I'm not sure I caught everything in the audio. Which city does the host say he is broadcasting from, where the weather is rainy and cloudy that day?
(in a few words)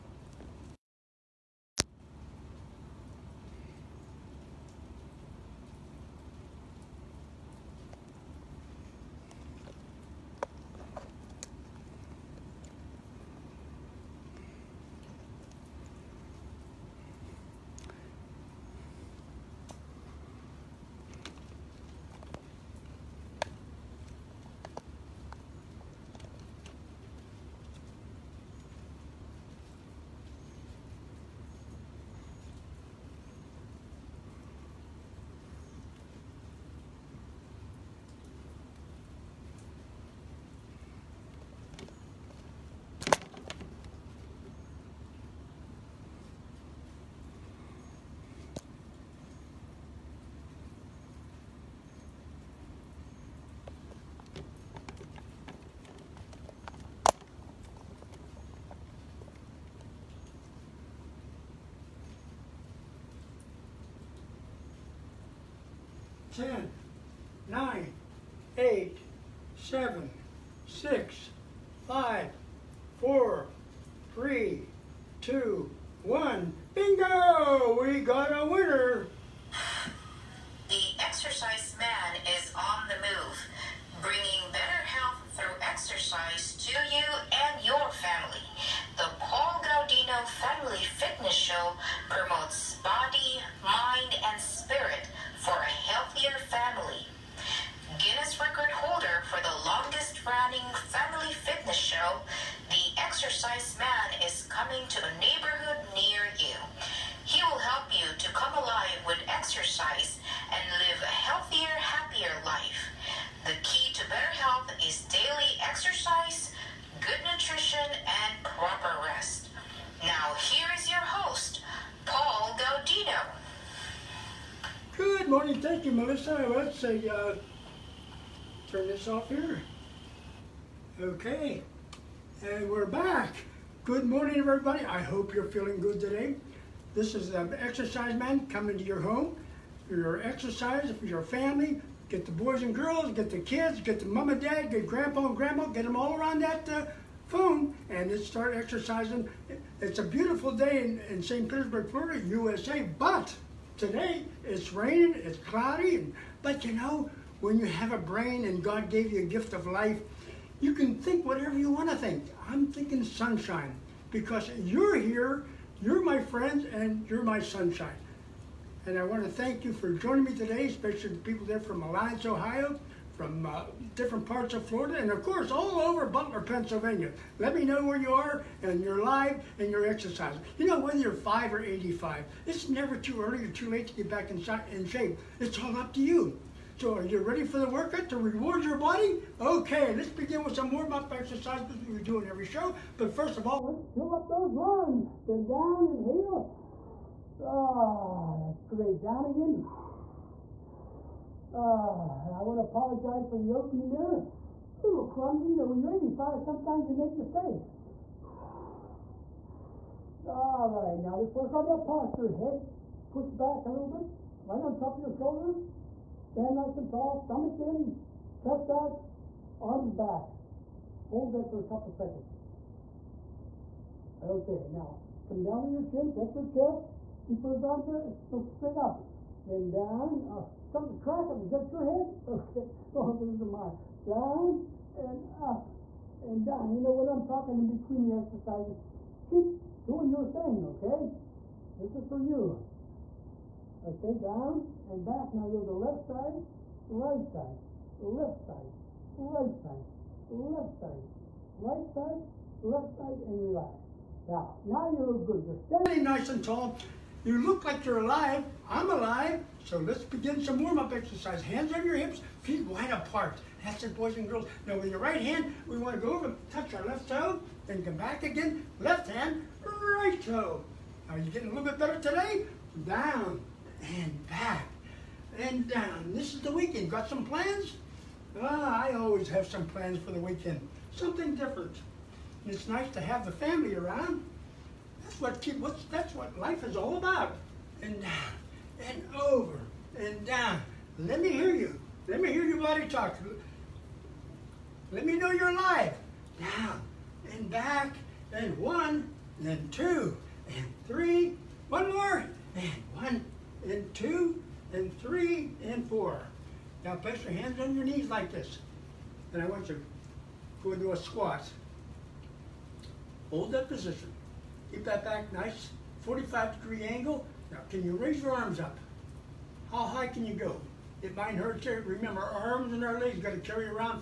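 St. Petersburg.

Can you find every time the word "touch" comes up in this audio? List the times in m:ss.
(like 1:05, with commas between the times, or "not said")
3:46, 4:26.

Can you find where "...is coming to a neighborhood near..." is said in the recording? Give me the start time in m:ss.
1:44.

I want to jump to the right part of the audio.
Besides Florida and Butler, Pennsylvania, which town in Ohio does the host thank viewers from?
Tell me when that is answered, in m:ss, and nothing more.
2:51.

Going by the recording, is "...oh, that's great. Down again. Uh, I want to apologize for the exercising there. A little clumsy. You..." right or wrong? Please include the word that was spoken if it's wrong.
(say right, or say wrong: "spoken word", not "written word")
wrong: "opening", not "exercising".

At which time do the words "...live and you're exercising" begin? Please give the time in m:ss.
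2:59.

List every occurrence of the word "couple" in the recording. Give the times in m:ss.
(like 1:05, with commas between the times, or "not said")
3:41.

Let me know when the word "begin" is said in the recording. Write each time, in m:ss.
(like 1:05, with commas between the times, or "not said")
3:10, 4:20.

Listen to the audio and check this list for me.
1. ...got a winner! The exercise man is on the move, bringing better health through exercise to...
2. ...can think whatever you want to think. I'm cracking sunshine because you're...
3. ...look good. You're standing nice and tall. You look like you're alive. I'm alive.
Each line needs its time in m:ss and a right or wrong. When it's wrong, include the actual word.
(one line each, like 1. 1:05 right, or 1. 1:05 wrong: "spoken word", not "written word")
1. 1:18 right
2. 2:40 wrong: "thinking", not "cracking"
3. 4:15 right.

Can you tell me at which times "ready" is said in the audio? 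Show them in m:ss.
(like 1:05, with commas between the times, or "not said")
3:07.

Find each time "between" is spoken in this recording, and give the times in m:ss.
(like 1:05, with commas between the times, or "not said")
3:57.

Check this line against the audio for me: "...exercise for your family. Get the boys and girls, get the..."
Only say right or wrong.
right.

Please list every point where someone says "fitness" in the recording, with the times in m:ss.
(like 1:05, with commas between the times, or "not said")
1:30, 1:41.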